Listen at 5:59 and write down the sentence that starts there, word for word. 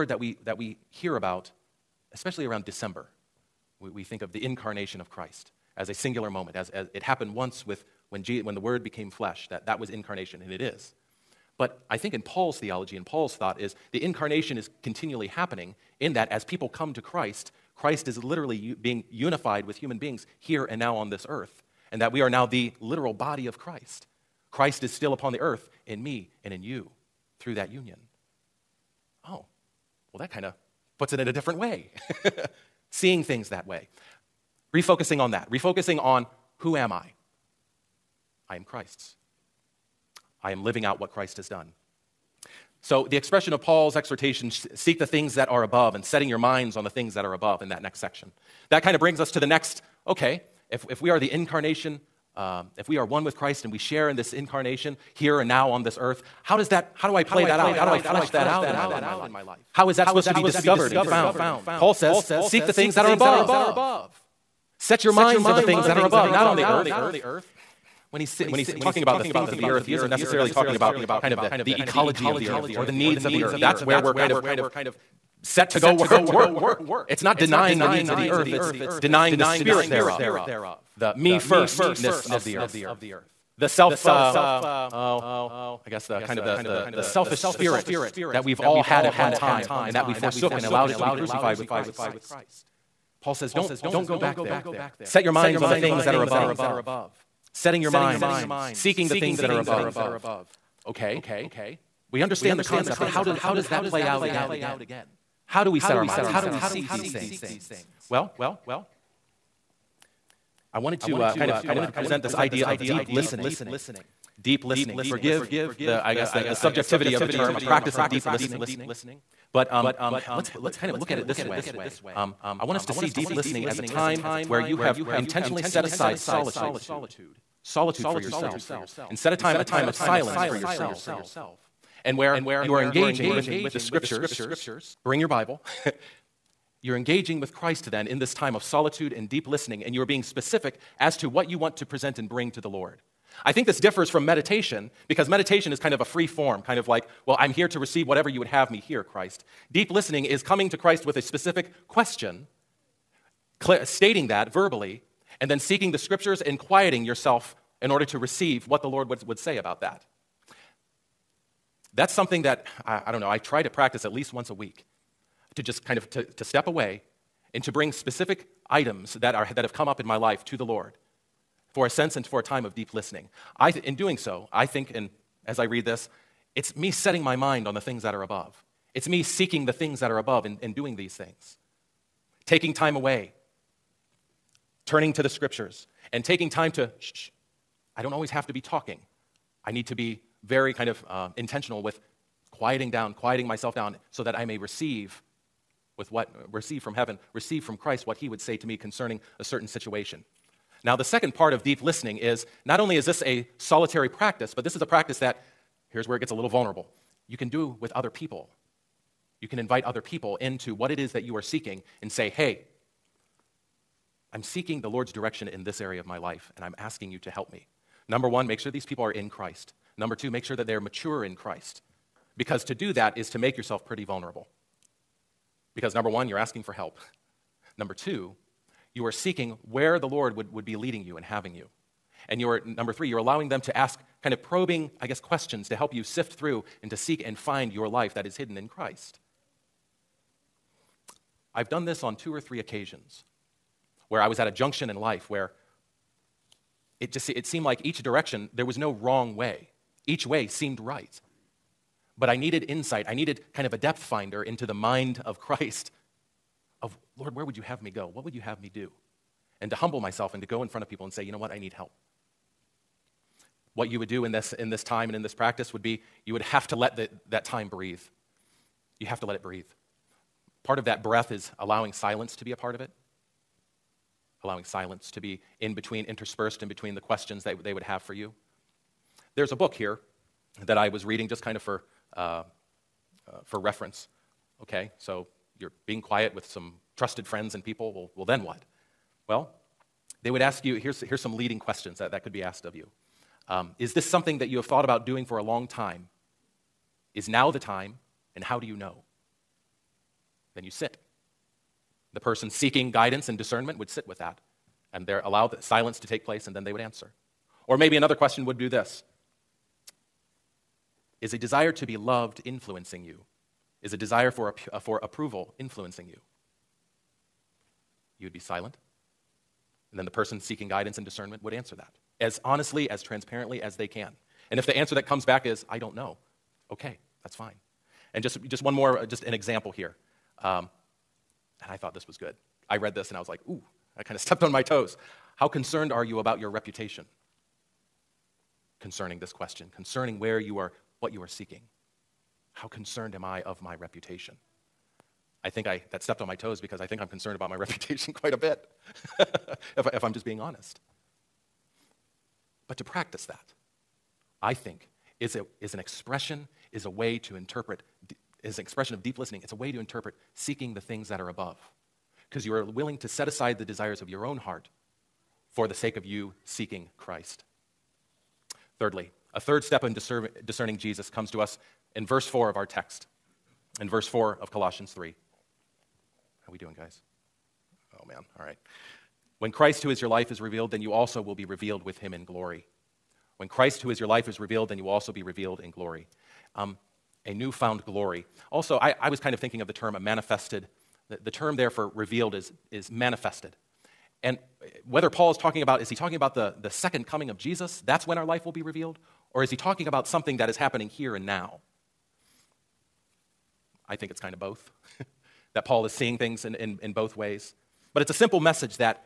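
It's a way to interpret seeking the things that are above.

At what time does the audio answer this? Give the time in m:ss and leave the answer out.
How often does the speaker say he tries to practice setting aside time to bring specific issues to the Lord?
2:44.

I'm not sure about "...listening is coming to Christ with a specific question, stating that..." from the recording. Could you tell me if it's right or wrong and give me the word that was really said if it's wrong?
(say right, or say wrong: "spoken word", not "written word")
right.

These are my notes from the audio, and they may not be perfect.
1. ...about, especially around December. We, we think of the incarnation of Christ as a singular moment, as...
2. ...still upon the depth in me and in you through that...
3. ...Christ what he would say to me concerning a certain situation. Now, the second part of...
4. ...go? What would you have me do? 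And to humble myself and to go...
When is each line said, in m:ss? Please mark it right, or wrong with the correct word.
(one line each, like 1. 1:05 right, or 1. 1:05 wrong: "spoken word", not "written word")
1. 0:01 right
2. 0:24 wrong: "earth", not "depth"
3. 3:17 right
4. 4:17 right.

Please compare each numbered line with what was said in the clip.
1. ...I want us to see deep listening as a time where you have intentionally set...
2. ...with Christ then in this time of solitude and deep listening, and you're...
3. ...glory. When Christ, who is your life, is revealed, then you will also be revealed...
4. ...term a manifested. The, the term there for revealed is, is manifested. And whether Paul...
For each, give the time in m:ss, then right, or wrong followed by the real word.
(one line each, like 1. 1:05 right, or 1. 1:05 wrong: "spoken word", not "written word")
1. 2:02 right
2. 2:17 right
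3. 6:22 right
4. 6:29 right.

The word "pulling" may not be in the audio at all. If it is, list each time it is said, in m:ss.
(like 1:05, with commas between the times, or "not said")
not said.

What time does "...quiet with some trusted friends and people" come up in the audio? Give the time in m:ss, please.
4:46.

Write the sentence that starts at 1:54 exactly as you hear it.
Forgive the, I guess, the, the subjectivity of the term, a practice of deep listening.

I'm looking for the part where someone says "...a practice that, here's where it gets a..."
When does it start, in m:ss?
3:24.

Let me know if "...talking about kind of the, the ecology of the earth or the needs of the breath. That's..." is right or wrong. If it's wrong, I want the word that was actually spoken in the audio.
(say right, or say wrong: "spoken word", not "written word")
wrong: "earth", not "breath".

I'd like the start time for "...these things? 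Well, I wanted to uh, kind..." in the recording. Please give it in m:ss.
1:46.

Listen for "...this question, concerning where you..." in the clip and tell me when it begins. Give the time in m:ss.
5:39.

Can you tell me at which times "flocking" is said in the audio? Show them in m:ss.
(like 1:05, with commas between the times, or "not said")
not said.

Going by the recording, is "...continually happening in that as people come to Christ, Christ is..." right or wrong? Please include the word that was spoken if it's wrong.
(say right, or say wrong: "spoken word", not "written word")
right.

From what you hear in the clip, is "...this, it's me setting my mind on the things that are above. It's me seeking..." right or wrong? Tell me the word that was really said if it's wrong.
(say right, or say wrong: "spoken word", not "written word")
right.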